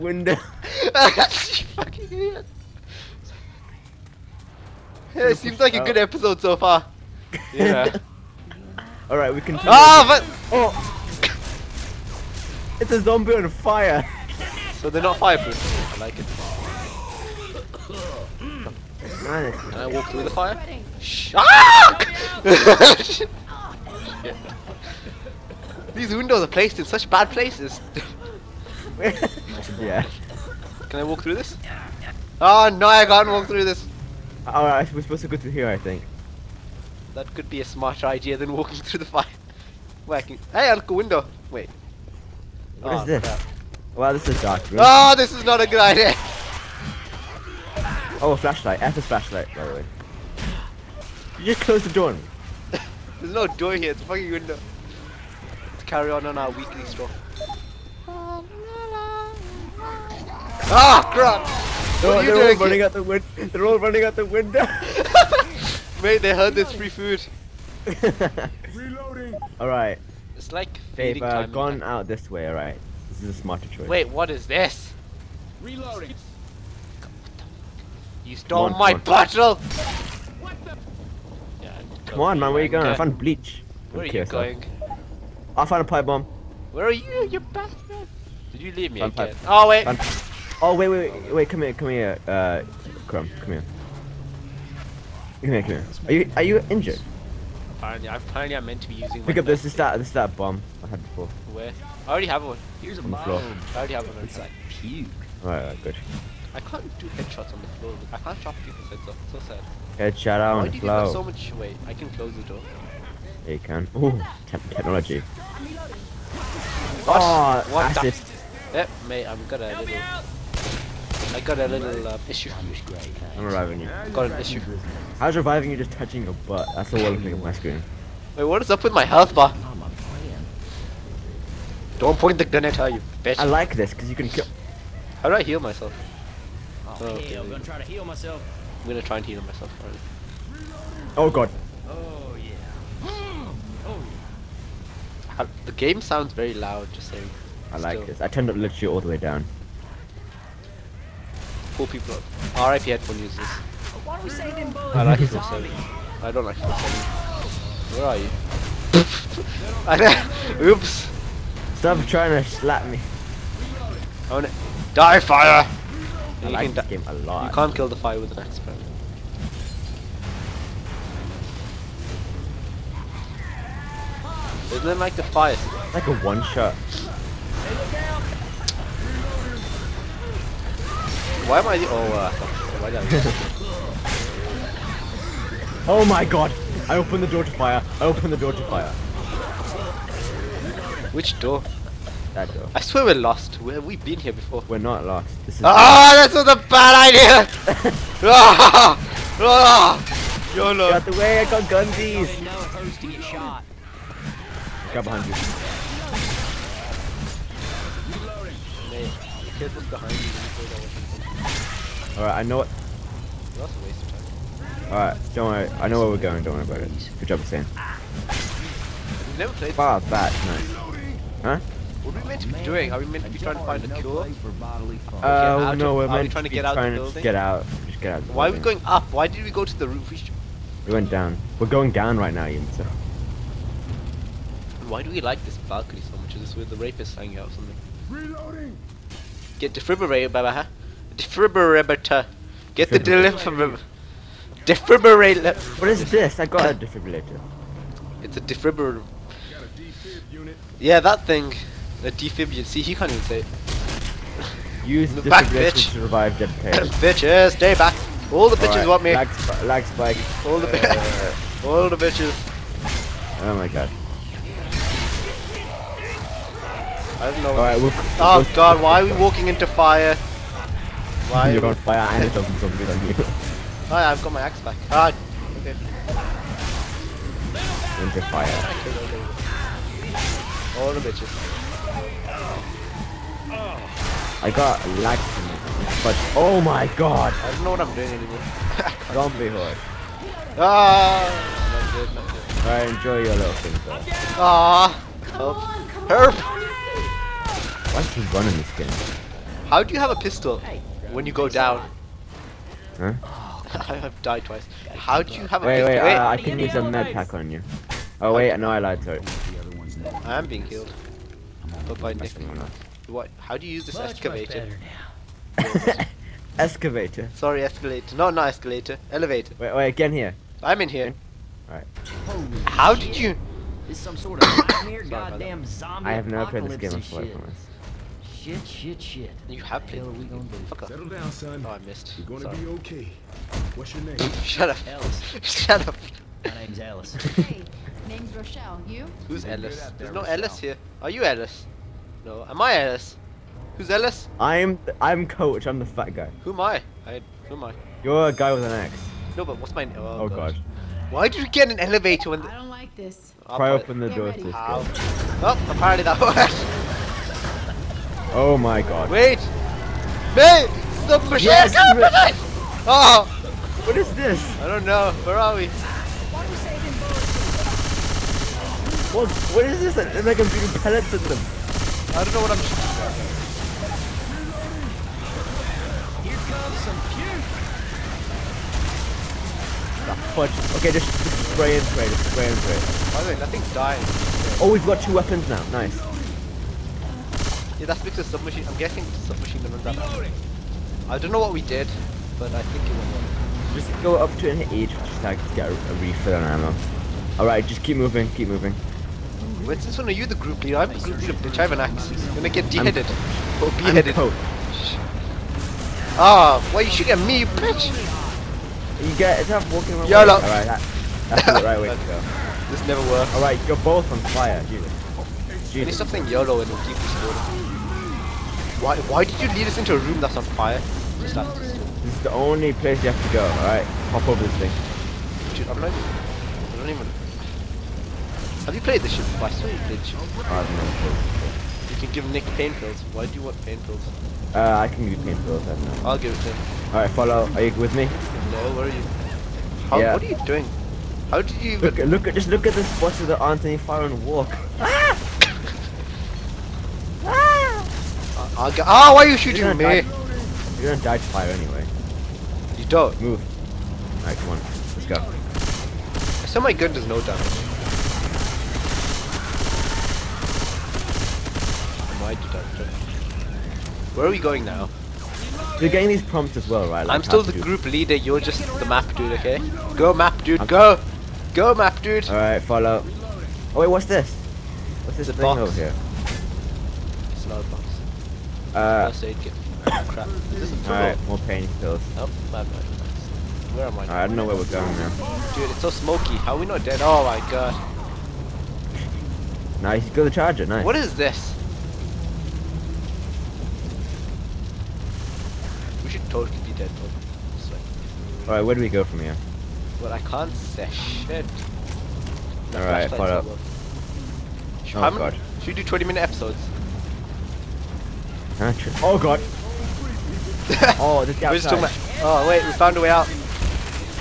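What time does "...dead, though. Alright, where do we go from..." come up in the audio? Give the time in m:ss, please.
8:16.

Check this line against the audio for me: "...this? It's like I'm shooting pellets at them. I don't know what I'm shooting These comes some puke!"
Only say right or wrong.
wrong.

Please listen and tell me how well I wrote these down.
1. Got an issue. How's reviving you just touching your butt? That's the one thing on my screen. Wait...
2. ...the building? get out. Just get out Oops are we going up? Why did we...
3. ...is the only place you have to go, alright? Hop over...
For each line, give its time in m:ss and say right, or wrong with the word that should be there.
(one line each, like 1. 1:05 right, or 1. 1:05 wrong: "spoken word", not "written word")
1. 2:04 right
2. 3:46 wrong: "Why", not "Oops"
3. 7:01 right.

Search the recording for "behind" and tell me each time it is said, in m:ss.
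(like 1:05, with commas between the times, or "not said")
3:25, 3:29.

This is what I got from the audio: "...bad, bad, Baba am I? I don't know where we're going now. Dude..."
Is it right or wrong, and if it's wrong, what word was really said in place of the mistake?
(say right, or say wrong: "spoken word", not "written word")
wrong: "Where", not "Baba".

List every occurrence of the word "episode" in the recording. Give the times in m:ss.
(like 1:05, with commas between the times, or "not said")
0:06, 8:26.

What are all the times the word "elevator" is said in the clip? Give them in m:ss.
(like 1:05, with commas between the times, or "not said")
5:19, 5:51.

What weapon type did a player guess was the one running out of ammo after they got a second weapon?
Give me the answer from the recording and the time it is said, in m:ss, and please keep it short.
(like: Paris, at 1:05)
submachine gun, at 6:29.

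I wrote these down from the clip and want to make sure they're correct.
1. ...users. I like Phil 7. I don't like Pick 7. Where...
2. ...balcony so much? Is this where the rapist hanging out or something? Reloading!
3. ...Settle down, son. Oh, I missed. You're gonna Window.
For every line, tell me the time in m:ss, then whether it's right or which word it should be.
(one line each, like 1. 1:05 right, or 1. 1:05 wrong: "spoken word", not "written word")
1. 2:33 wrong: "Phil", not "Pick"
2. 3:55 right
3. 5:30 wrong: "Sorry", not "Window".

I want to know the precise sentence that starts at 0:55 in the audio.
Let's carry on on our weekly stuff.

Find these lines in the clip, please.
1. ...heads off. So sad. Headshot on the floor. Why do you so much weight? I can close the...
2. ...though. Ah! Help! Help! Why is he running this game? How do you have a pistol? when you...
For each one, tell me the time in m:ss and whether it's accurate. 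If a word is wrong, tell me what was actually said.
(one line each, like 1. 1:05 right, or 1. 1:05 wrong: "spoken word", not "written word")
1. 1:48 right
2. 4:53 right.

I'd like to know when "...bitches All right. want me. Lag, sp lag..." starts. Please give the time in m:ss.
4:18.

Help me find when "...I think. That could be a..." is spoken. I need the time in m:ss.
0:35.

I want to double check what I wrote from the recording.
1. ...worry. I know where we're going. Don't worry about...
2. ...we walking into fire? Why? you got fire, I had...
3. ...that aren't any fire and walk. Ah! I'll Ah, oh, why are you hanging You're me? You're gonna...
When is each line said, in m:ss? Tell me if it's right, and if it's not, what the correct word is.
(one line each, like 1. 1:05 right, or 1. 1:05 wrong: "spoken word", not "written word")
1. 3:35 right
2. 4:29 right
3. 7:23 wrong: "shooting", not "hanging".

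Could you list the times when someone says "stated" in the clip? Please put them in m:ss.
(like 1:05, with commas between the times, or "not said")
not said.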